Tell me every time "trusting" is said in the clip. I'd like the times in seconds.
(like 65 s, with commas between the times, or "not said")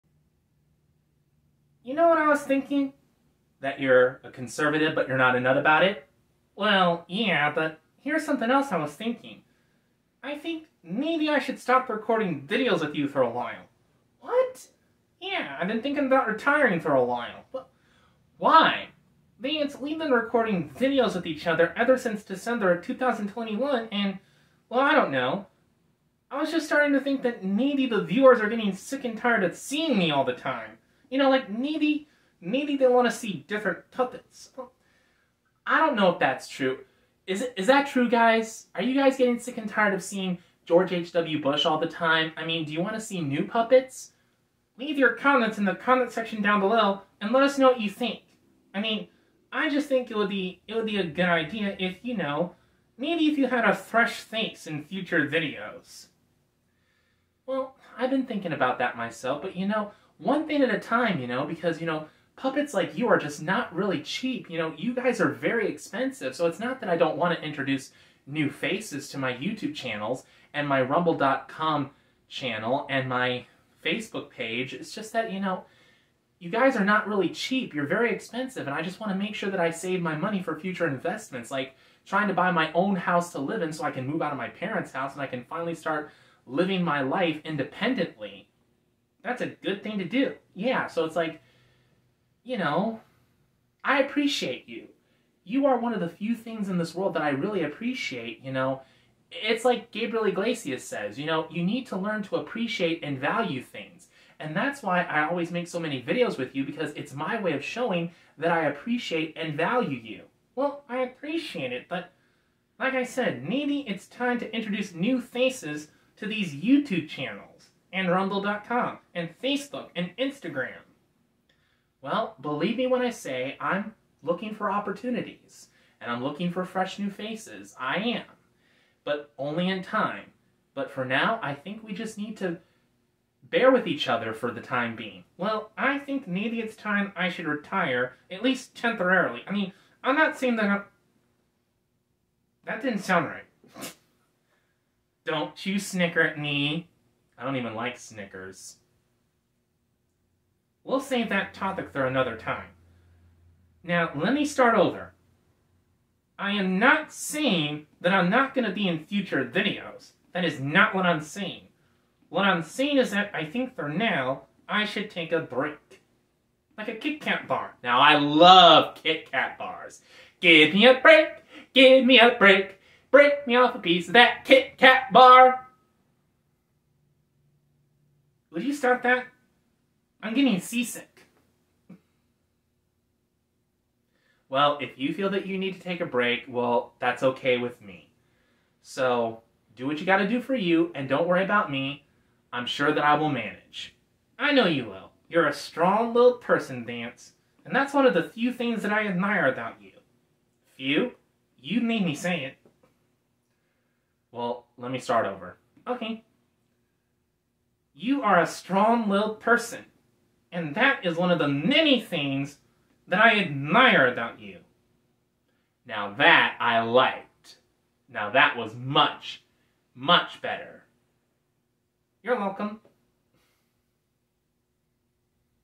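not said.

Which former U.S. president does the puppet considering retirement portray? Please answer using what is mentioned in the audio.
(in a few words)
George H.W. Bush.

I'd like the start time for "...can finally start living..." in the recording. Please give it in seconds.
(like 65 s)
85 s.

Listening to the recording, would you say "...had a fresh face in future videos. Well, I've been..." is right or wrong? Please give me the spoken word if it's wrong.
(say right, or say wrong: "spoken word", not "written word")
right.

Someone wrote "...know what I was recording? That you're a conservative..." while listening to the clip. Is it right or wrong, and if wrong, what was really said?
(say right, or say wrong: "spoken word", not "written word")
wrong: "thinking", not "recording".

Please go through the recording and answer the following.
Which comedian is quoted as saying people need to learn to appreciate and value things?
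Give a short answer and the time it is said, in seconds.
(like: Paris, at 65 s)
Gabriel Iglesias, at 99 s.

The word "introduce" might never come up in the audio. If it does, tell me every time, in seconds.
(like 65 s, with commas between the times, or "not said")
67 s, 114 s.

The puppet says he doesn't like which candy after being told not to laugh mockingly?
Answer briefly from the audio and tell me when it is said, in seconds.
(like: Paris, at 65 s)
Snickers, at 147 s.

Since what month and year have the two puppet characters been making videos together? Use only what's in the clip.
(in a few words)
December 2021.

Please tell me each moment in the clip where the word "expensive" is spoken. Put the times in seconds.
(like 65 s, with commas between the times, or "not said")
65 s, 78 s.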